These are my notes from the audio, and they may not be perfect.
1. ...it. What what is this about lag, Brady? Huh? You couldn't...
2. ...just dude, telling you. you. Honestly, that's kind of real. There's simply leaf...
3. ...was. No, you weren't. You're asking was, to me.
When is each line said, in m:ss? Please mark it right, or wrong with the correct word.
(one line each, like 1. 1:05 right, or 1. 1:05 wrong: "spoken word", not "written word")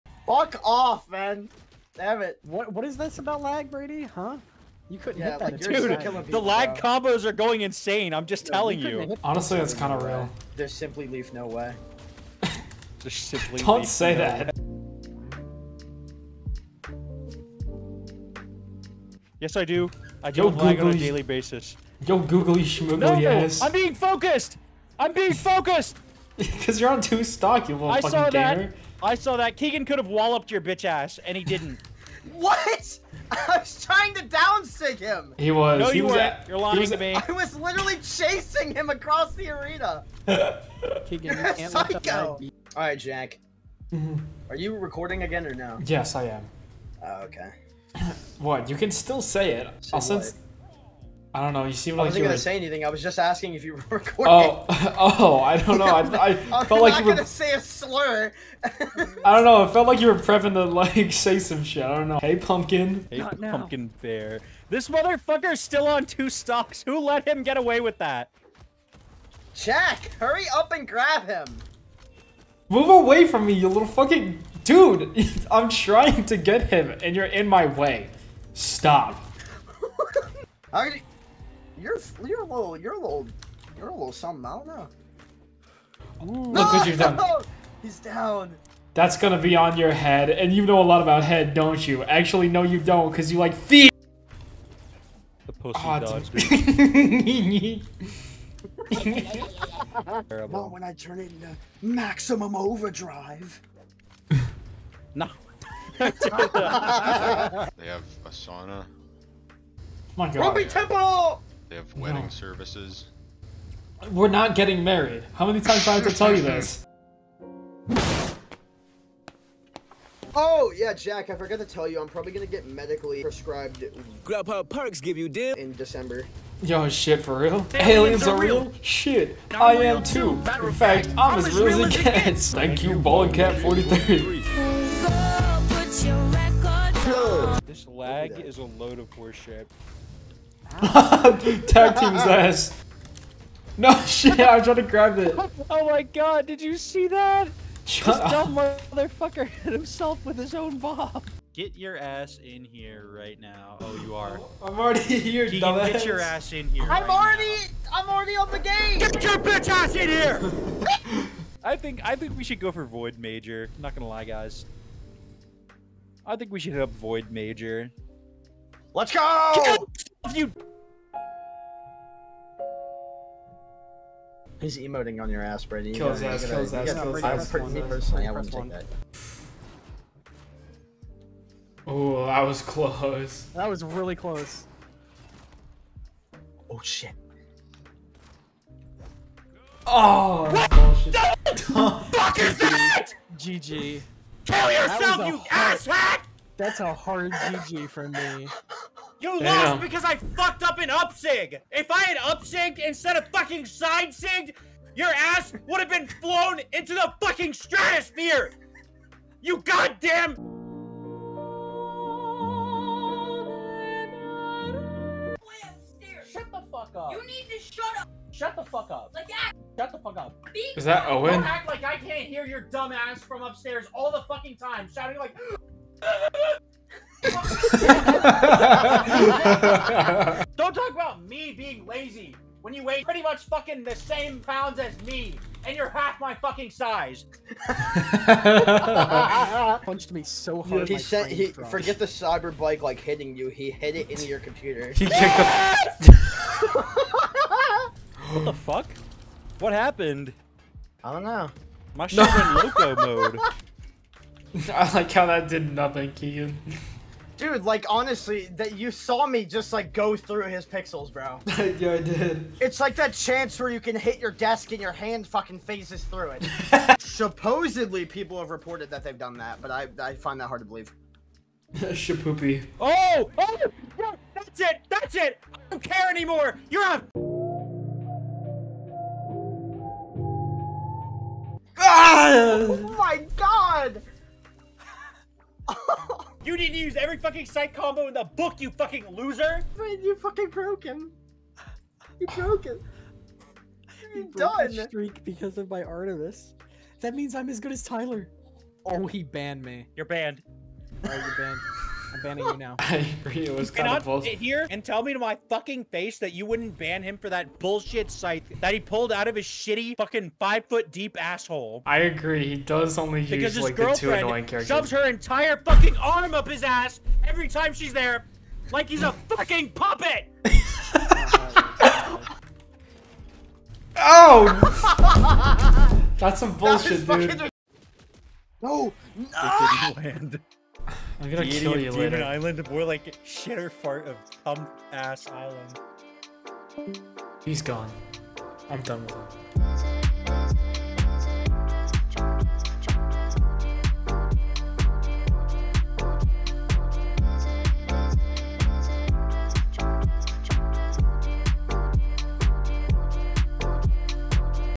1. 0:02 right
2. 0:08 right
3. 0:35 wrong: "lying", not "asking".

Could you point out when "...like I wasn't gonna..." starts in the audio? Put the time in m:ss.
0:51.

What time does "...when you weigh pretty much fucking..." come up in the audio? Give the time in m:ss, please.
3:52.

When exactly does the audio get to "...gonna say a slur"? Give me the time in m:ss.
0:57.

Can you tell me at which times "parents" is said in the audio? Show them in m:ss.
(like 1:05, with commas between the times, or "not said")
not said.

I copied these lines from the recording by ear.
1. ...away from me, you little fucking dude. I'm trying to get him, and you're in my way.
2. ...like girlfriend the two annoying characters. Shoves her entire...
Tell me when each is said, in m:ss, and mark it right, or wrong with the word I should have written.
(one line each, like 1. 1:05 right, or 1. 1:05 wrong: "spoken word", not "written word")
1. 1:12 right
2. 5:13 right.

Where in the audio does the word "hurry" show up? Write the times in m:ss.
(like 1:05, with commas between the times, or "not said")
1:10.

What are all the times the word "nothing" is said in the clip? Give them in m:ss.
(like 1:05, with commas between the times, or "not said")
4:15.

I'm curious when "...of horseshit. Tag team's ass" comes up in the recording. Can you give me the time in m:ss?
2:18.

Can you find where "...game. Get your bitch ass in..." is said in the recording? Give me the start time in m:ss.
2:38.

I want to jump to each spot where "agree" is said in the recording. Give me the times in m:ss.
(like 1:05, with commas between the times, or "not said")
5:03, 5:11.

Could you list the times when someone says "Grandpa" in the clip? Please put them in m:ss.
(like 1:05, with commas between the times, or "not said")
2:04.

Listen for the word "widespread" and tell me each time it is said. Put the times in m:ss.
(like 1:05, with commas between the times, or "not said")
not said.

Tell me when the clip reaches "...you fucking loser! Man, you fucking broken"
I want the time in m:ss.
4:48.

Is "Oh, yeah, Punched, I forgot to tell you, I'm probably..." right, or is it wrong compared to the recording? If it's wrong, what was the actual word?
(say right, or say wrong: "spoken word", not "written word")
wrong: "Jack", not "Punched".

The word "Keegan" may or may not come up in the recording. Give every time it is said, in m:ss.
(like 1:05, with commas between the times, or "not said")
0:29, 0:41, 2:35, 4:16.